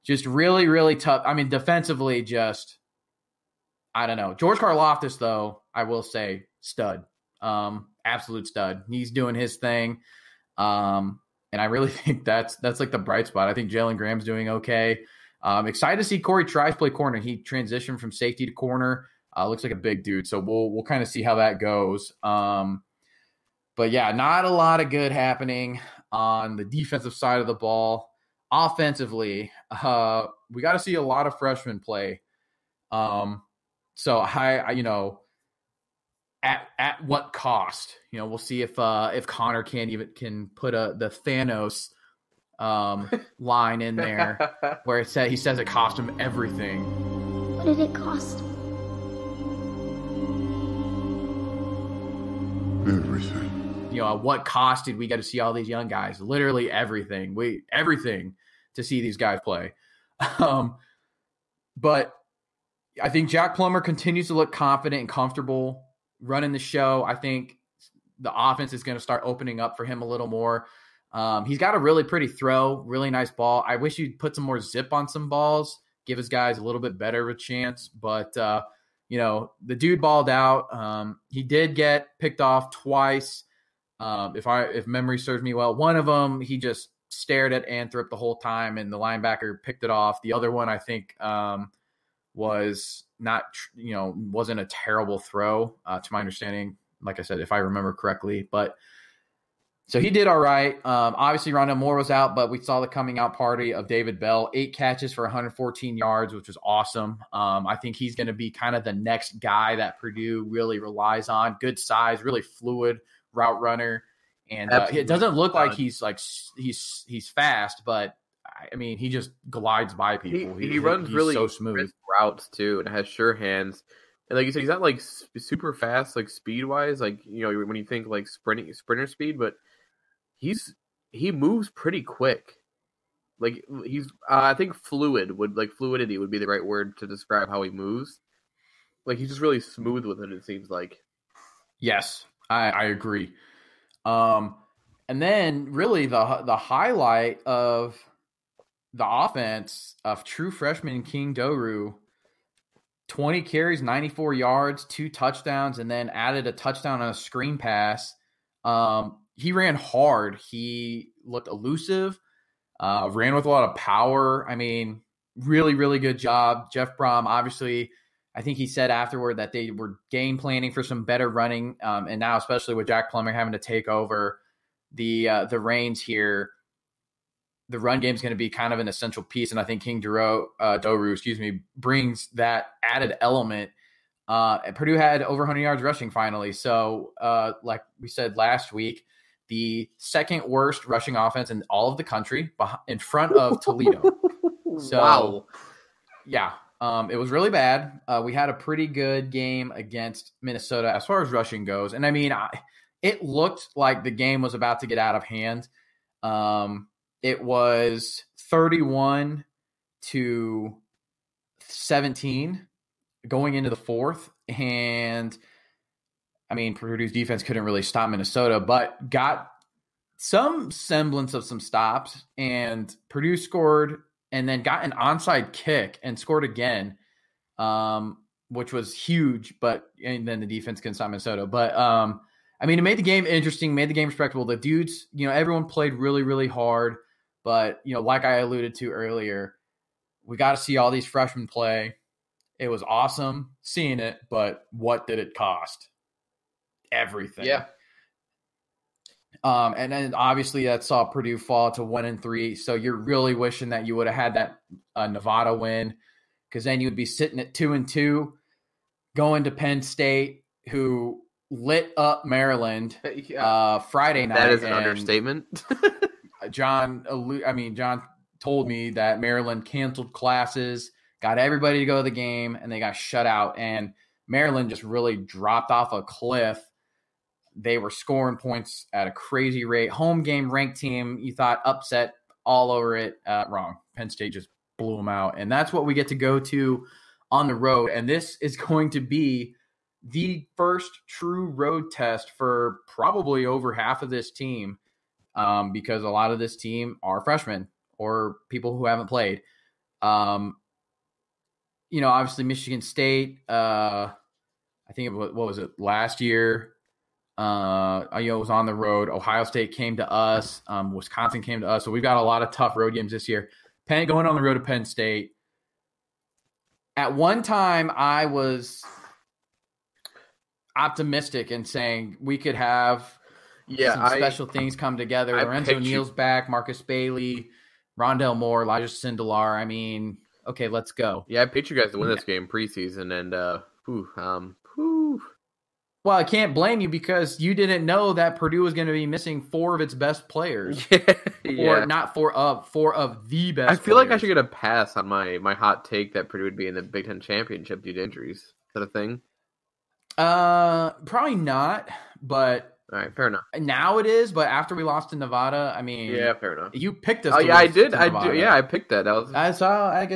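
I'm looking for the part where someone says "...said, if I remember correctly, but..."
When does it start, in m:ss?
1:37.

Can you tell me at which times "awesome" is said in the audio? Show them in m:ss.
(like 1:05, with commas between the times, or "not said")
1:46, 4:02.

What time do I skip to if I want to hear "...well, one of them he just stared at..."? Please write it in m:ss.
1:25.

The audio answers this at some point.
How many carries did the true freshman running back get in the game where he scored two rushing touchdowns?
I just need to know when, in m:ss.
2:33.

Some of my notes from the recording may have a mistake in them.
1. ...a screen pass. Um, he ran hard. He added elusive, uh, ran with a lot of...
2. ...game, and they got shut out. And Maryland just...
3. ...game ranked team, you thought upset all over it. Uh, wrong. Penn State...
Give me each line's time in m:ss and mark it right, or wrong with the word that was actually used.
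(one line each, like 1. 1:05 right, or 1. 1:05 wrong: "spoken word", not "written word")
1. 2:37 wrong: "looked", not "added"
2. 4:32 right
3. 4:40 right.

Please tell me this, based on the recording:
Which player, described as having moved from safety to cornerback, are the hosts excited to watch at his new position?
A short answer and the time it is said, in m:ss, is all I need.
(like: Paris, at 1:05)
Cory Trice, at 0:16.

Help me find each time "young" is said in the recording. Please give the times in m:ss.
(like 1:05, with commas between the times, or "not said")
0:55.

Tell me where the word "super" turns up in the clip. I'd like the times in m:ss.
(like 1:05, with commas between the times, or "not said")
2:05.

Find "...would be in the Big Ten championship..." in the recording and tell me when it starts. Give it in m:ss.
5:46.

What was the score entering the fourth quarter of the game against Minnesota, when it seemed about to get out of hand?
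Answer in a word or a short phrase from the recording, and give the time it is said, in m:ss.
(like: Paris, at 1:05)
31 to 17, at 3:28.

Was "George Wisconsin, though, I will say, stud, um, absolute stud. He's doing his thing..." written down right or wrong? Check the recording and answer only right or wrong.
wrong.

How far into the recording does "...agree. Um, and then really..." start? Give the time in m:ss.
2:22.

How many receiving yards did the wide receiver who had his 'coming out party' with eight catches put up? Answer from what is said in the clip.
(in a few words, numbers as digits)
114.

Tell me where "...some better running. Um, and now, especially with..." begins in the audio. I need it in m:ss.
2:50.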